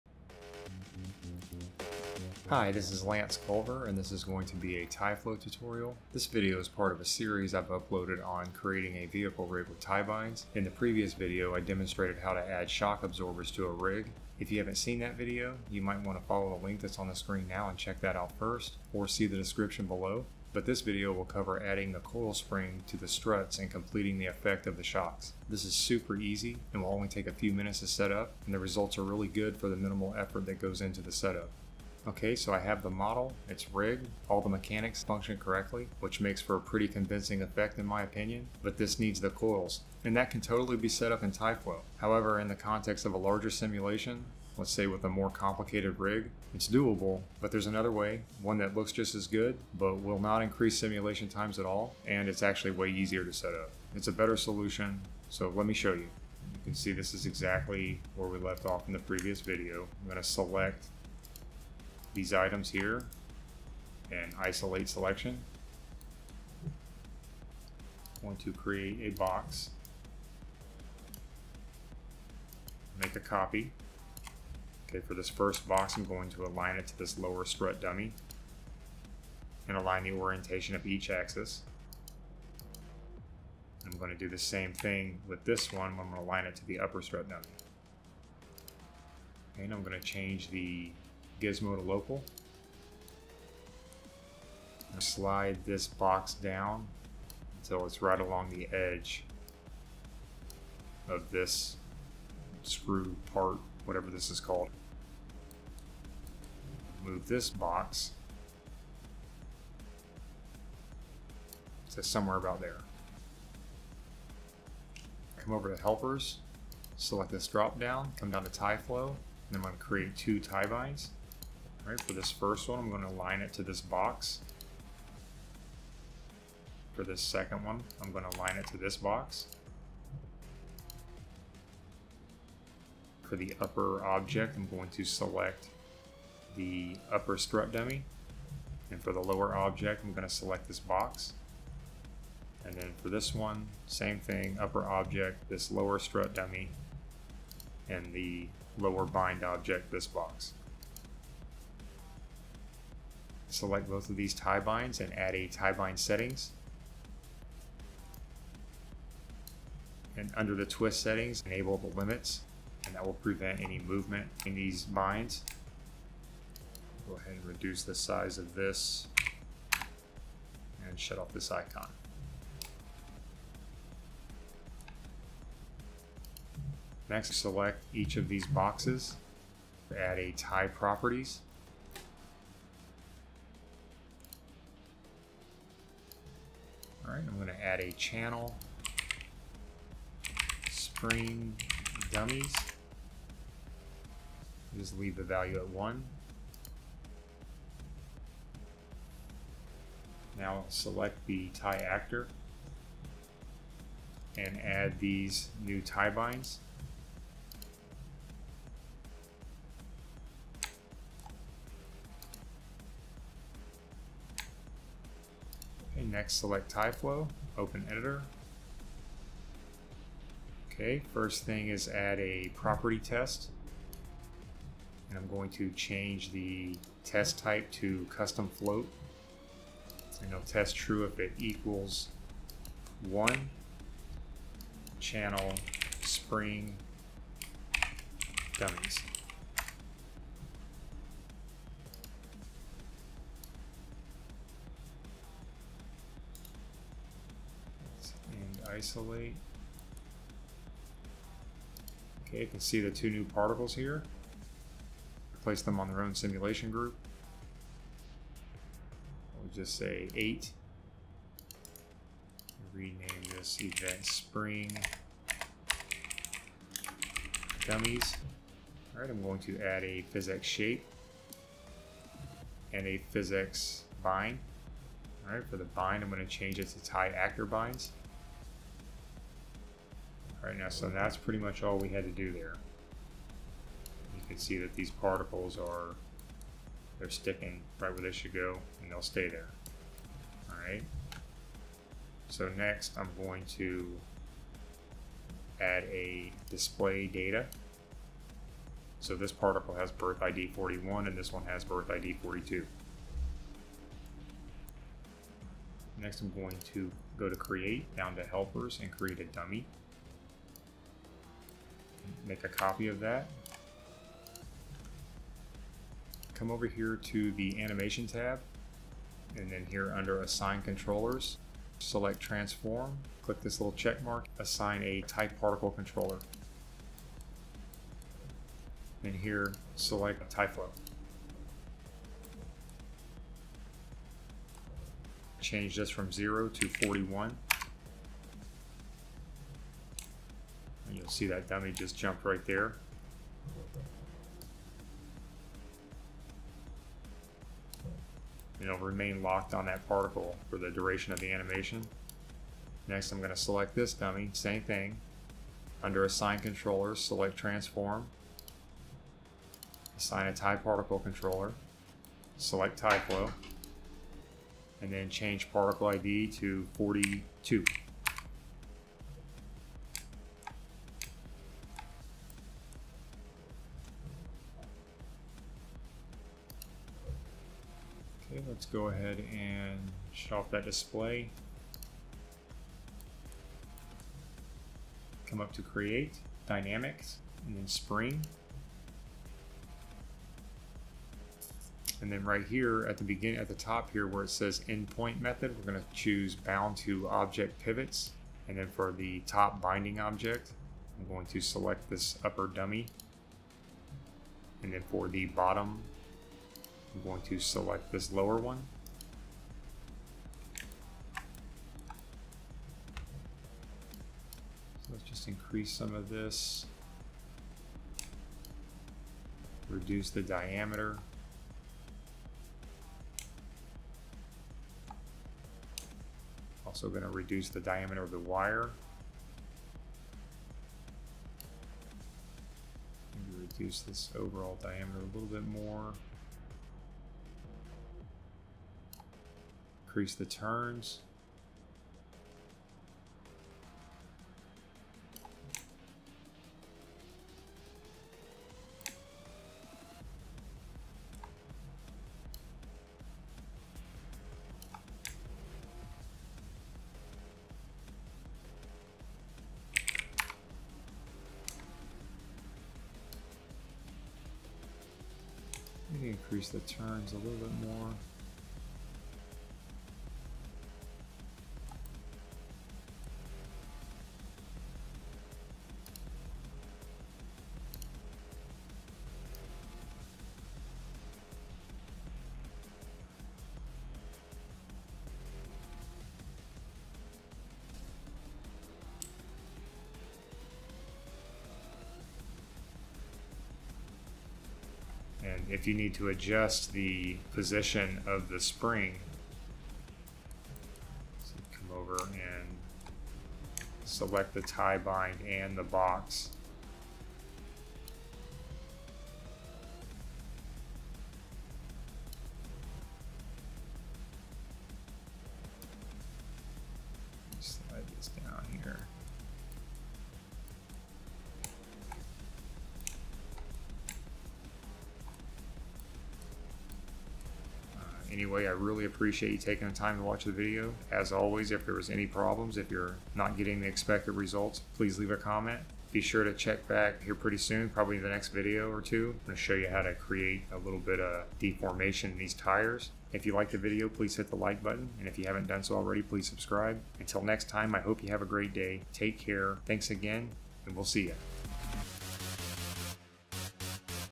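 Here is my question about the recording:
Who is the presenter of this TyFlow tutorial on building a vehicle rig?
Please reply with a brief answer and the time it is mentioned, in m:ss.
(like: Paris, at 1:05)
Lance Culver, at 0:03.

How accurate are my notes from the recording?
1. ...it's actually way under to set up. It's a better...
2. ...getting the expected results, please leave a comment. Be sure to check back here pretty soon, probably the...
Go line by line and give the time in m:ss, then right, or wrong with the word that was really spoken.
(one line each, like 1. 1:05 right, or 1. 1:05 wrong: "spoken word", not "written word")
1. 0:52 wrong: "easier", not "under"
2. 8:53 right.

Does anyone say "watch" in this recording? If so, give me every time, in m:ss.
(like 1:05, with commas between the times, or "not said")
8:50.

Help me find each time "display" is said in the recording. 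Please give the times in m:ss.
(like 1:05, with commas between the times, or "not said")
4:56, 6:20.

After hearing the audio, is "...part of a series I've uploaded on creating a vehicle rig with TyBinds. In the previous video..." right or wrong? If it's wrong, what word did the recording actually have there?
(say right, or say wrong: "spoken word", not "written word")
right.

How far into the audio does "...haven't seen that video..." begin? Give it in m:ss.
0:14.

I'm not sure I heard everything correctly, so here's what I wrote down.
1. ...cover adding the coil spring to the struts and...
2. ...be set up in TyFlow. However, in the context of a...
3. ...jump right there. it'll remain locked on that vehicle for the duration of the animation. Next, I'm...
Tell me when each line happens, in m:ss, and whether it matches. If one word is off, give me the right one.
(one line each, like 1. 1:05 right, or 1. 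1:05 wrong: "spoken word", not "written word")
1. 0:21 right
2. 0:40 right
3. 5:41 wrong: "particle", not "vehicle".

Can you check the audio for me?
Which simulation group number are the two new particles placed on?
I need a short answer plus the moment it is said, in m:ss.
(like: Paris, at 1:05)
8, at 4:20.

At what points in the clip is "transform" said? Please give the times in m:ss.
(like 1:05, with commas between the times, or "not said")
5:22, 5:57.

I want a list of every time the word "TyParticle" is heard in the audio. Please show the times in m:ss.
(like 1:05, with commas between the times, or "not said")
5:25, 6:00.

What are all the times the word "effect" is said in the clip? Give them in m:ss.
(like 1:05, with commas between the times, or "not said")
0:24, 0:37.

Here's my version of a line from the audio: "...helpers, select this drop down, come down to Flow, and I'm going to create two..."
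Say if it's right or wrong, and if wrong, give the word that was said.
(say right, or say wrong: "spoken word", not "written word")
wrong: "TyFlow", not "Flow".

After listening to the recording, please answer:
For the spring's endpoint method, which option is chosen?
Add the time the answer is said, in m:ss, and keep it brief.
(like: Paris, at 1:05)
bound to object pivots, at 6:36.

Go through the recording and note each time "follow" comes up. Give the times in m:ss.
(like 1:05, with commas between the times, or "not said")
0:16.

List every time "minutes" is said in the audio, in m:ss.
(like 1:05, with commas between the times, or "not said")
0:27.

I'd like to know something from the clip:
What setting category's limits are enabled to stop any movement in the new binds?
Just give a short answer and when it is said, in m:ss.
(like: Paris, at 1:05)
twist settings, at 2:40.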